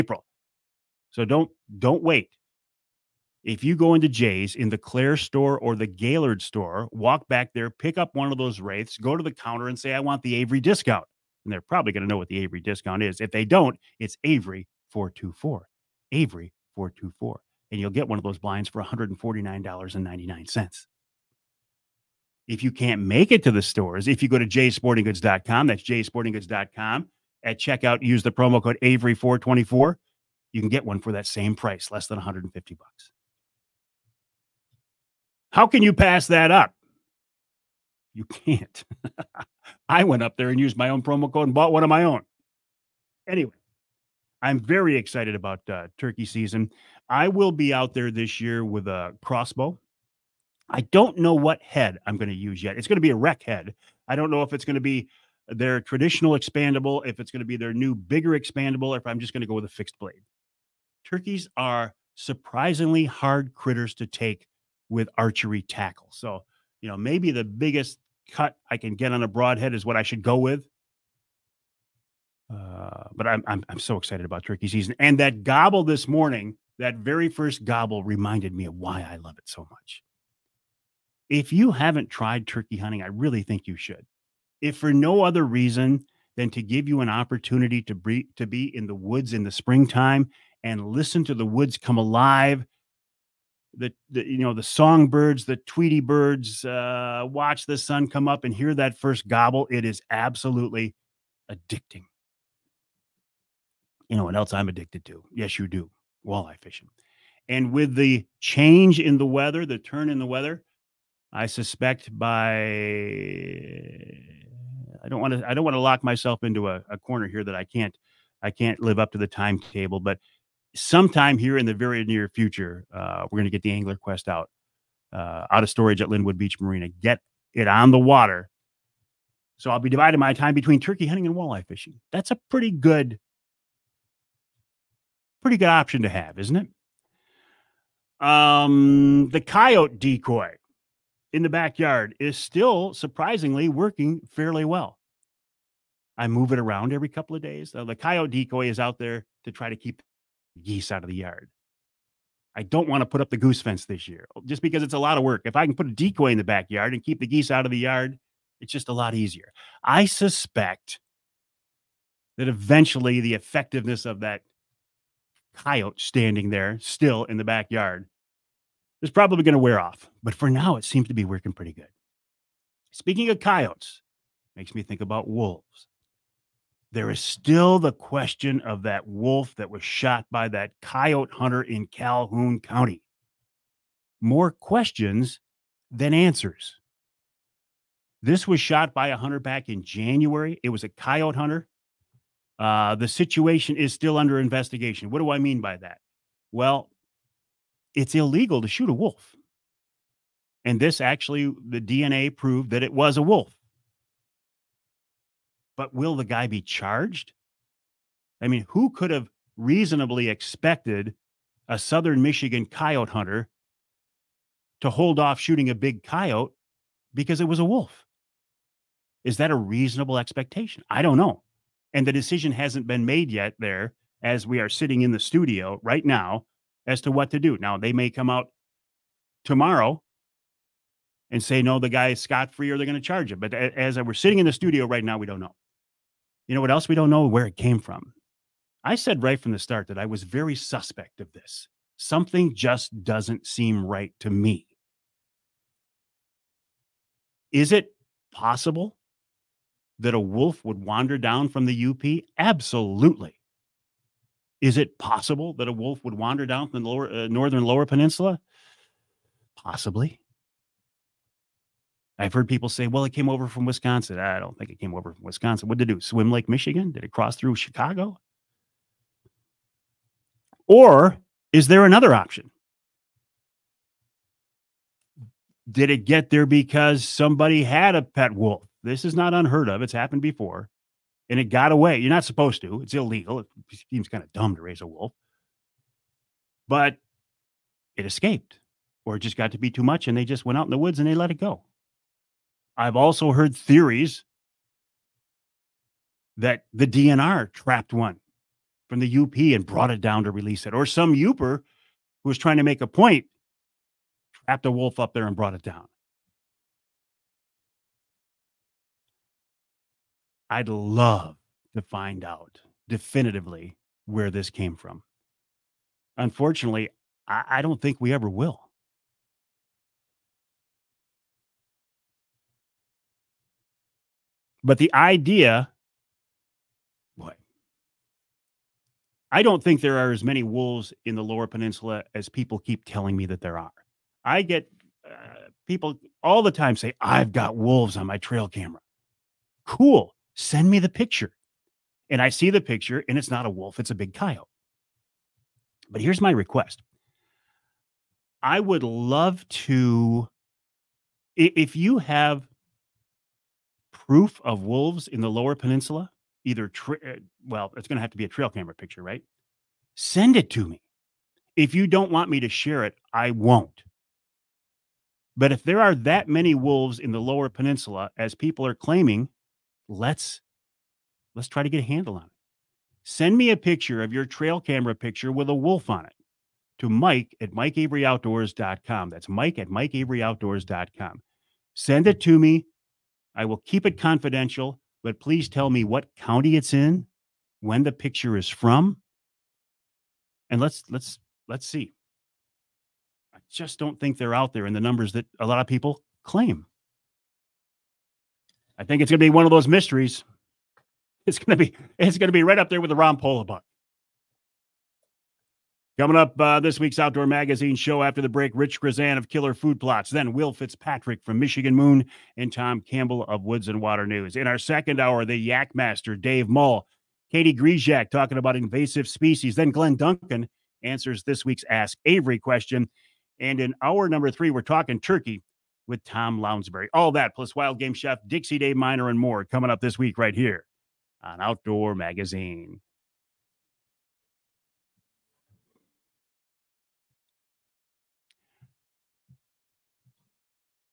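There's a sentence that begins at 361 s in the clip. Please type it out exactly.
If you don't want me to share it, I won't.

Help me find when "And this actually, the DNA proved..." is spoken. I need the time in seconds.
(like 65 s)
200 s.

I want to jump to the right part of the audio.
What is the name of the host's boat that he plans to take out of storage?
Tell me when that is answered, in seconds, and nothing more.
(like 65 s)
123 s.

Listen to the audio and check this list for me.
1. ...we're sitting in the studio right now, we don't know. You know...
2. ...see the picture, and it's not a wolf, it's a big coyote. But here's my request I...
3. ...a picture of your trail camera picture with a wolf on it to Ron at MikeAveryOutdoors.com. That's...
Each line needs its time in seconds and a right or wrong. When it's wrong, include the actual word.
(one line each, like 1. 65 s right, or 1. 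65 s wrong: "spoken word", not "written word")
1. 233 s right
2. 342 s right
3. 373 s wrong: "Mike", not "Ron".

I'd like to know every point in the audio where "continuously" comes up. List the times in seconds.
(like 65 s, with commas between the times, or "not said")
not said.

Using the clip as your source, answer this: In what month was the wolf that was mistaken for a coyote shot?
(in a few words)
January.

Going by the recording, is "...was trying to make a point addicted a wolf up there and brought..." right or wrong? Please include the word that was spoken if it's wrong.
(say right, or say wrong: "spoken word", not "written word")
wrong: "trapped", not "addicted".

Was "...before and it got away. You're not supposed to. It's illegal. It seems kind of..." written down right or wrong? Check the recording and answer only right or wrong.
right.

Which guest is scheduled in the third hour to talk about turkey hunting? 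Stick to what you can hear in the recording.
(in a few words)
Tom Lounsbury.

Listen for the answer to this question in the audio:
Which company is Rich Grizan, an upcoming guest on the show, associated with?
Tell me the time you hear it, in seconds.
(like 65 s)
409 s.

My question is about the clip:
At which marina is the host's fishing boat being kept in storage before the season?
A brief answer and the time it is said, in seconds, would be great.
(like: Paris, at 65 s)
Linwood Beach Marina, at 126 s.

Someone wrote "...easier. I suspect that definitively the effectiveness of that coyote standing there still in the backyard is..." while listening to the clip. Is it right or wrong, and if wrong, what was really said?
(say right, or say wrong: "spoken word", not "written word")
wrong: "eventually", not "definitively".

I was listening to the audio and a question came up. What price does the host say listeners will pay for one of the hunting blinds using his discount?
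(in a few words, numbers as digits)
$149.99.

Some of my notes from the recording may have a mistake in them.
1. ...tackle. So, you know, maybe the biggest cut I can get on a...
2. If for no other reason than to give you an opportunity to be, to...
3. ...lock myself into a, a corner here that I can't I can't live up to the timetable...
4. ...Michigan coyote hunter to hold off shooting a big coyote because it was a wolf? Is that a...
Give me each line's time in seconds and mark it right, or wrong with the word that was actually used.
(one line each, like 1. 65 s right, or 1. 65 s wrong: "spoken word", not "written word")
1. 65 s right
2. 84 s right
3. 115 s right
4. 212 s right.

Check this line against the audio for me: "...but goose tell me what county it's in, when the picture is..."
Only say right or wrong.
wrong.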